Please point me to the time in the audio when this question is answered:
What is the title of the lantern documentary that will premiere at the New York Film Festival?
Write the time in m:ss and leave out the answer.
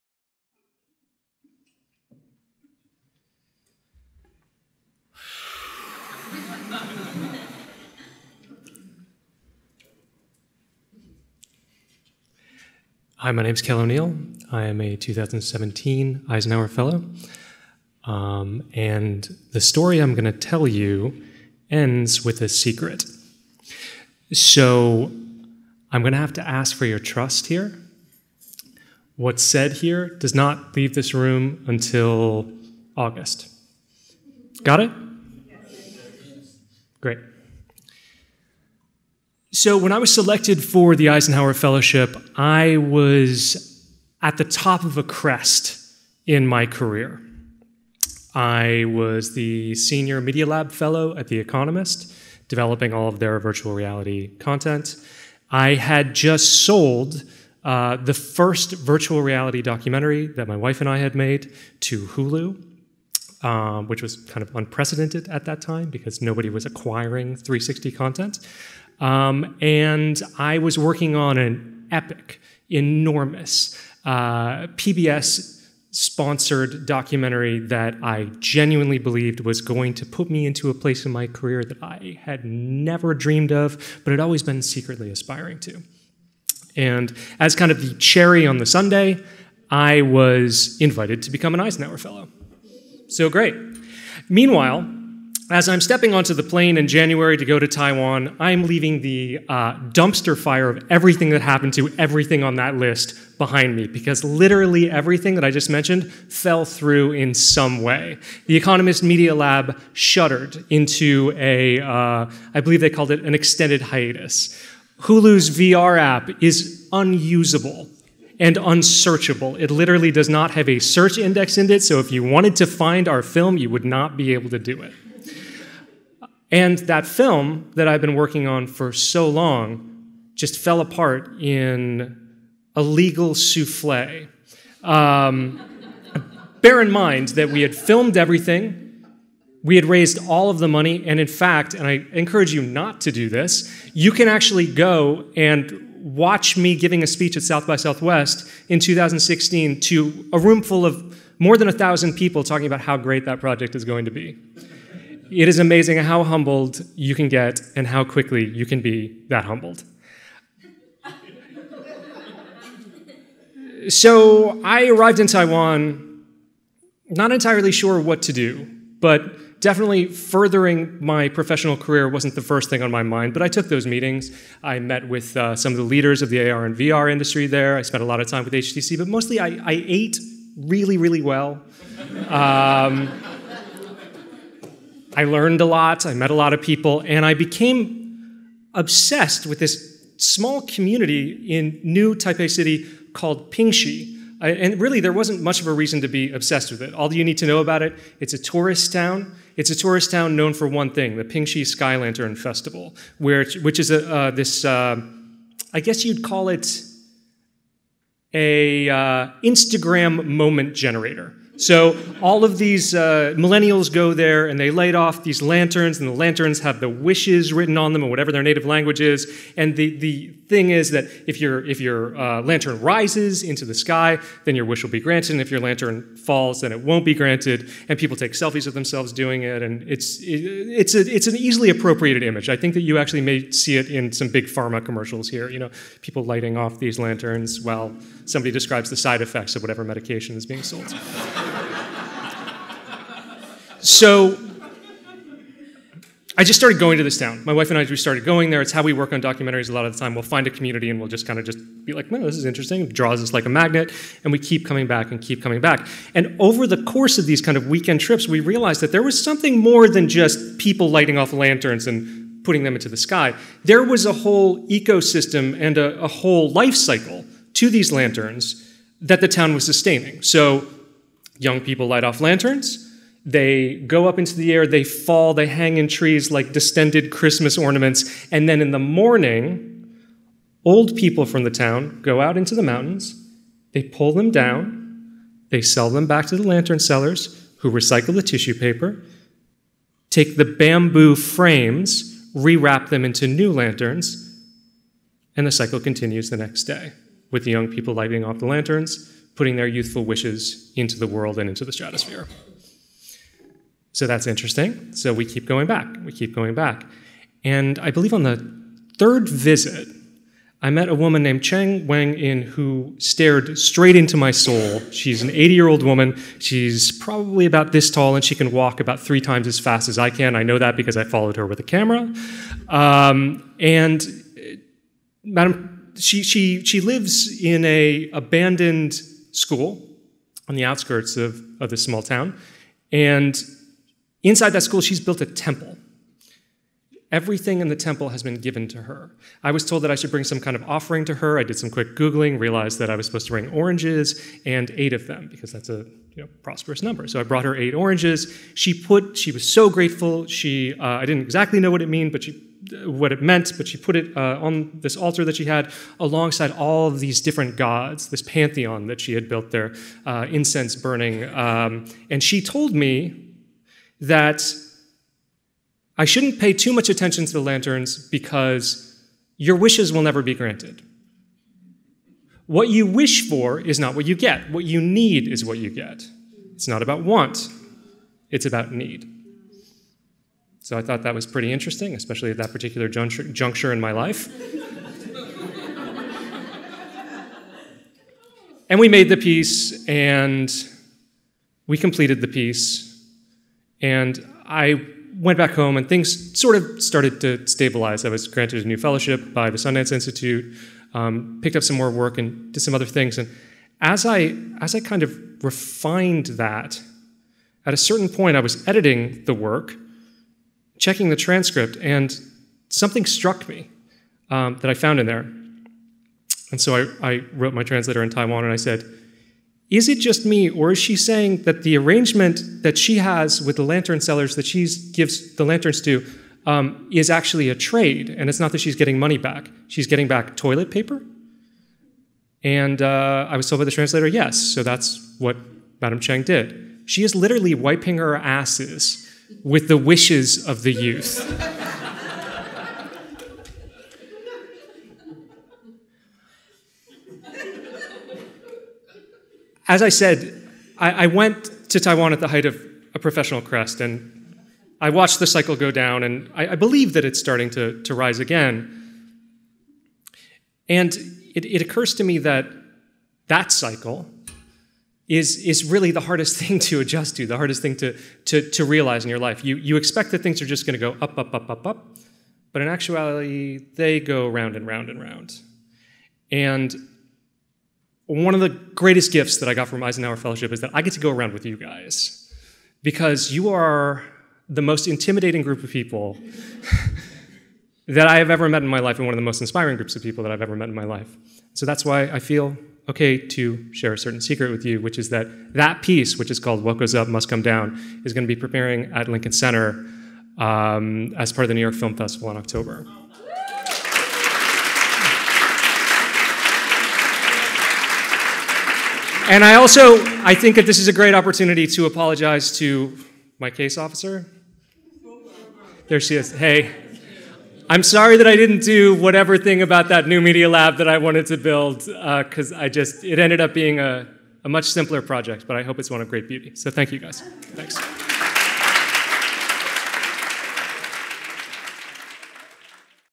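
8:16.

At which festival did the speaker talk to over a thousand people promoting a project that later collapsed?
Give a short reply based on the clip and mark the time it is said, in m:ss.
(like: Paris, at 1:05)
South by Southwest, at 2:27.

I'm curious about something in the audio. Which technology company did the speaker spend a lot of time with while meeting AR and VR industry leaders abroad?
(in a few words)
HTC.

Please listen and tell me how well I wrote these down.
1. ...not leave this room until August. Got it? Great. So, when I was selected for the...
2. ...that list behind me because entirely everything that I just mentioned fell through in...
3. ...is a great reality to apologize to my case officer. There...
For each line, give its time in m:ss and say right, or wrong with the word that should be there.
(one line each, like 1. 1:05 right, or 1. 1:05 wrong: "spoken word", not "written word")
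1. 0:30 right
2. 1:42 wrong: "literally", not "entirely"
3. 8:30 wrong: "opportunity", not "reality".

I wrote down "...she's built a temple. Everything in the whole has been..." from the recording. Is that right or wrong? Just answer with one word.
wrong.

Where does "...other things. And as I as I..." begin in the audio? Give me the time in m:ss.
6:42.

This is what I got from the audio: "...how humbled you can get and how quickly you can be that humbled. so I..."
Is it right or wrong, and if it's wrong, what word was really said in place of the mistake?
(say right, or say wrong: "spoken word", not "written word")
right.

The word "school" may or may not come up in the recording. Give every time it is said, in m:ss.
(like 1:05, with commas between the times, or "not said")
5:29, 5:34.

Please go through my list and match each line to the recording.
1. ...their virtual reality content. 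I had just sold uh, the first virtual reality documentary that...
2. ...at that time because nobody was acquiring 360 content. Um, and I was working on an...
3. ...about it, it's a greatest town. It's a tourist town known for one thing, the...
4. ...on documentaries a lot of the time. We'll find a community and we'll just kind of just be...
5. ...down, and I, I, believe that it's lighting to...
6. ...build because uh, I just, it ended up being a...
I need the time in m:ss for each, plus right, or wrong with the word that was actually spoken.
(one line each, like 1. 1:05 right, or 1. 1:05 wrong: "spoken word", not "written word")
1. 0:53 right
2. 1:05 right
3. 3:17 wrong: "tourist", not "greatest"
4. 4:09 right
5. 7:35 wrong: "starting", not "lighting"
6. 8:41 right.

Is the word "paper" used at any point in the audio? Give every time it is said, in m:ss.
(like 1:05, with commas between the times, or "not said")
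4:48, 7:10.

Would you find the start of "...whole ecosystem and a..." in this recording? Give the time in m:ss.
4:24.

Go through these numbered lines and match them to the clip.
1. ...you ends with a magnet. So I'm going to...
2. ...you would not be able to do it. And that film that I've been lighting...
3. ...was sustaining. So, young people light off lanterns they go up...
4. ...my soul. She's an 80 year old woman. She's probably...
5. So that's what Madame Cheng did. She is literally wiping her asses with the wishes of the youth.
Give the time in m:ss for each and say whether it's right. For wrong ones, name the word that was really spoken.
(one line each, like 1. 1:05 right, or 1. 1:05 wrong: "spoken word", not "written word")
1. 0:20 wrong: "secret", not "magnet"
2. 2:03 wrong: "working", not "lighting"
3. 4:29 right
4. 5:14 right
5. 7:14 right.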